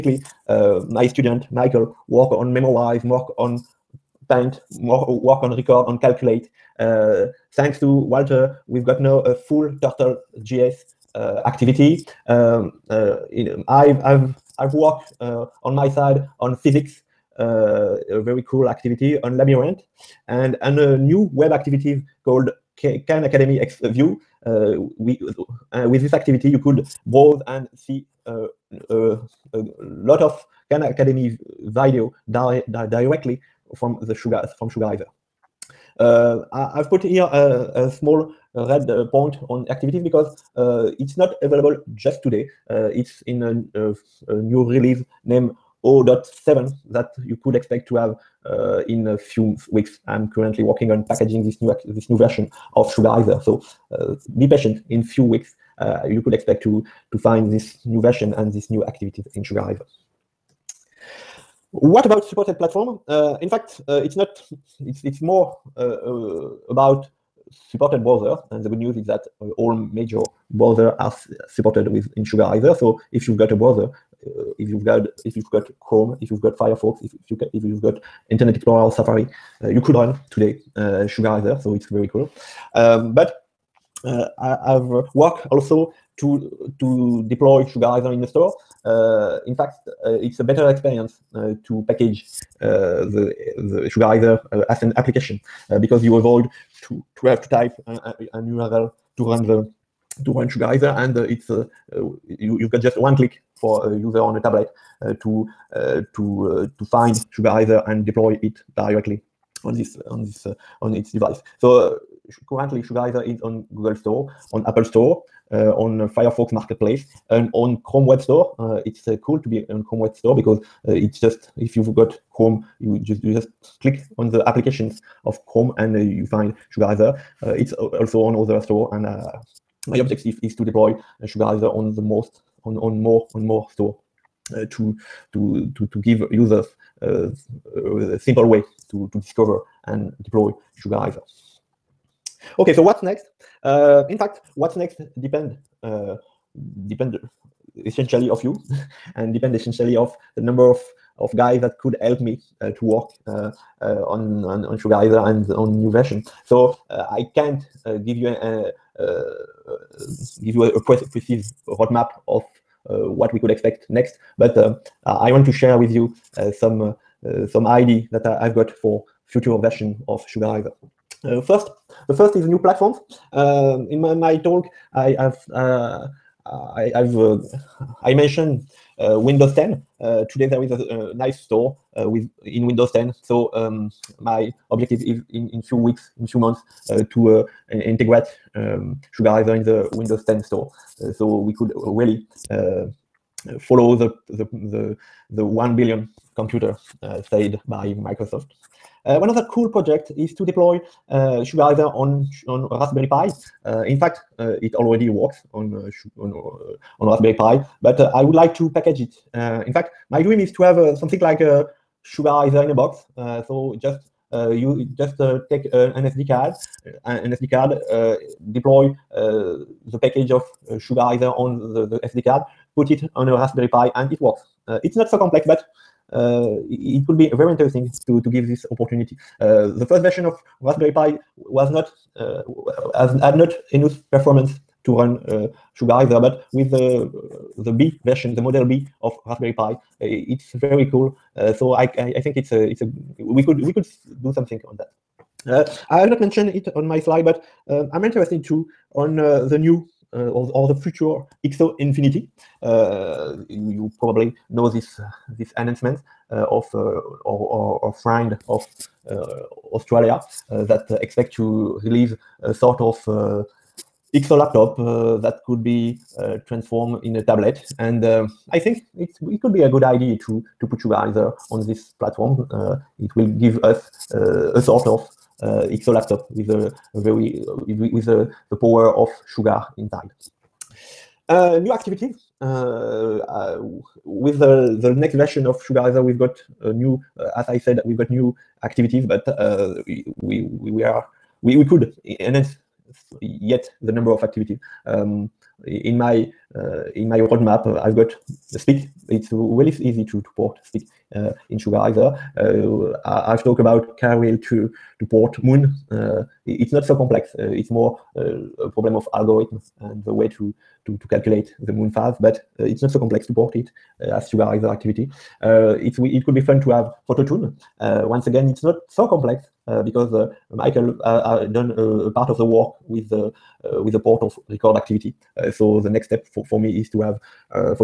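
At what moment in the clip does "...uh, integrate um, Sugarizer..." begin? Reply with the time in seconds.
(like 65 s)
187 s.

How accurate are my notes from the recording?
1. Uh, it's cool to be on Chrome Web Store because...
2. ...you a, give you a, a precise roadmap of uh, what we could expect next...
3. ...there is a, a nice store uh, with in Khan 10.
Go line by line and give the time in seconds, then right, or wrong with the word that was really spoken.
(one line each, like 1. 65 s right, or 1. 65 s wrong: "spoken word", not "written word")
1. 118 s right
2. 158 s right
3. 180 s wrong: "Windows", not "Khan".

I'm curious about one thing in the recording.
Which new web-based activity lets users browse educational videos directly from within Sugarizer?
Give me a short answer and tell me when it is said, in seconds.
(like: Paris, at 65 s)
Khan Academy X View, at 22 s.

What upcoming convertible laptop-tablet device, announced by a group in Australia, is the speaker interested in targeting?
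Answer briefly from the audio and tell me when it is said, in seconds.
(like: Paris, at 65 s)
XO Infinity, at 251 s.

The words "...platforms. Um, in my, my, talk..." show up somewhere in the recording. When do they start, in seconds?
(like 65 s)
172 s.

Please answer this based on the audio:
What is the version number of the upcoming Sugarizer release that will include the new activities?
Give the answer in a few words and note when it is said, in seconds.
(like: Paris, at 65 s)
0.7, at 45 s.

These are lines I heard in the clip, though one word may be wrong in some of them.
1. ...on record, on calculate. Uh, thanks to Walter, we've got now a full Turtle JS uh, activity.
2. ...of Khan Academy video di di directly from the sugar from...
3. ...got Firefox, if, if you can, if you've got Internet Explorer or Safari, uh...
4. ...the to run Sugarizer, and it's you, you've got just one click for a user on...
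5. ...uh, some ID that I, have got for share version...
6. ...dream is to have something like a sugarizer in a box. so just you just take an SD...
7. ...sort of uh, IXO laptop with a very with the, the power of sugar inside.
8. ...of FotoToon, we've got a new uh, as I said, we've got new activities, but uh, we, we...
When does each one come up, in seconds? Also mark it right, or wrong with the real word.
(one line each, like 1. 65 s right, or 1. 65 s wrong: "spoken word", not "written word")
1. 5 s right
2. 30 s right
3. 76 s right
4. 99 s right
5. 167 s wrong: "future", not "share"
6. 210 s right
7. 274 s right
8. 285 s wrong: "Sugarizer", not "FotoToon".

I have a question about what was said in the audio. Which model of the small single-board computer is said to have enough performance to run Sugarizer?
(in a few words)
Model B.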